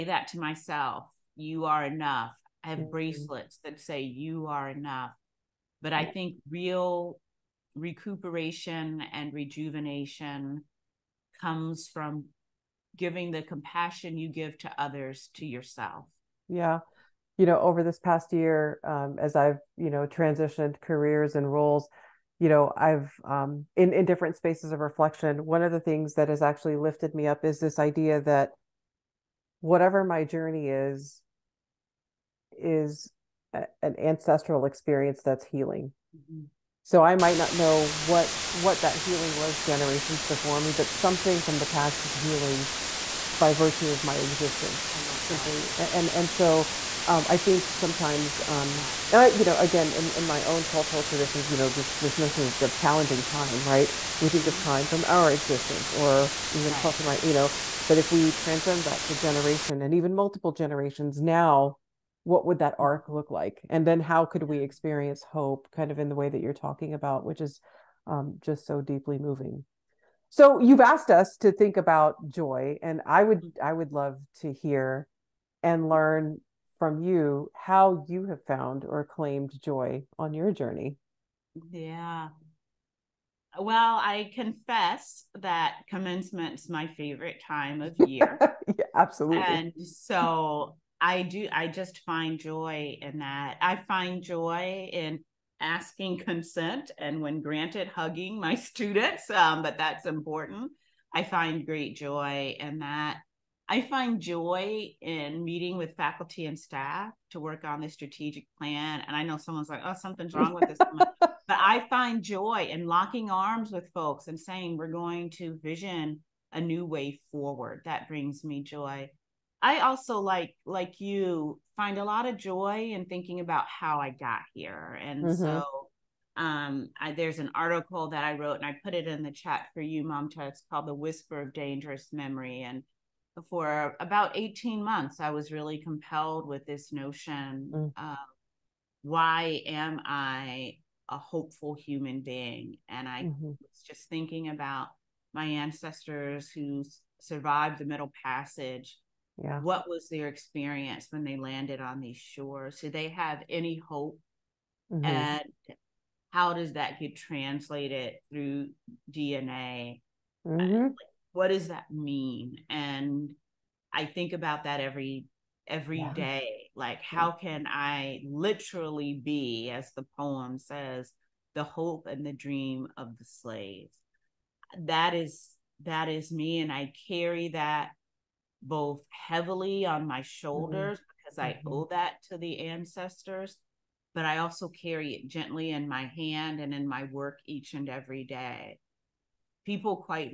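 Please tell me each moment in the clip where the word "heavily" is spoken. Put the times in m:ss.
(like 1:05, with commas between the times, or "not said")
2:59.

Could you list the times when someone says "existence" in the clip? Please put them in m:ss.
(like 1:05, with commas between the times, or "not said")
0:44, 0:55.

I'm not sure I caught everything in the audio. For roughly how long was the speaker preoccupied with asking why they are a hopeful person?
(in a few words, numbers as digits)
18 months.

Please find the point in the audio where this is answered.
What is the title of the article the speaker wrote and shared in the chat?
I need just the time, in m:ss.
2:10.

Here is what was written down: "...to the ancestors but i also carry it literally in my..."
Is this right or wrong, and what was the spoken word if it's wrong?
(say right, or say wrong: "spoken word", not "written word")
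wrong: "gently", not "literally".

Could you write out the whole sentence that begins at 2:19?
why am i a hopeful human being and i mm-hmm.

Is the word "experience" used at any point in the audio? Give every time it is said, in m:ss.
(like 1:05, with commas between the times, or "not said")
0:34, 1:04, 2:30.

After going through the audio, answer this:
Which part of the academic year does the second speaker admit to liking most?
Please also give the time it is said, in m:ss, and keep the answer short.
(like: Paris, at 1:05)
Commencement, at 1:25.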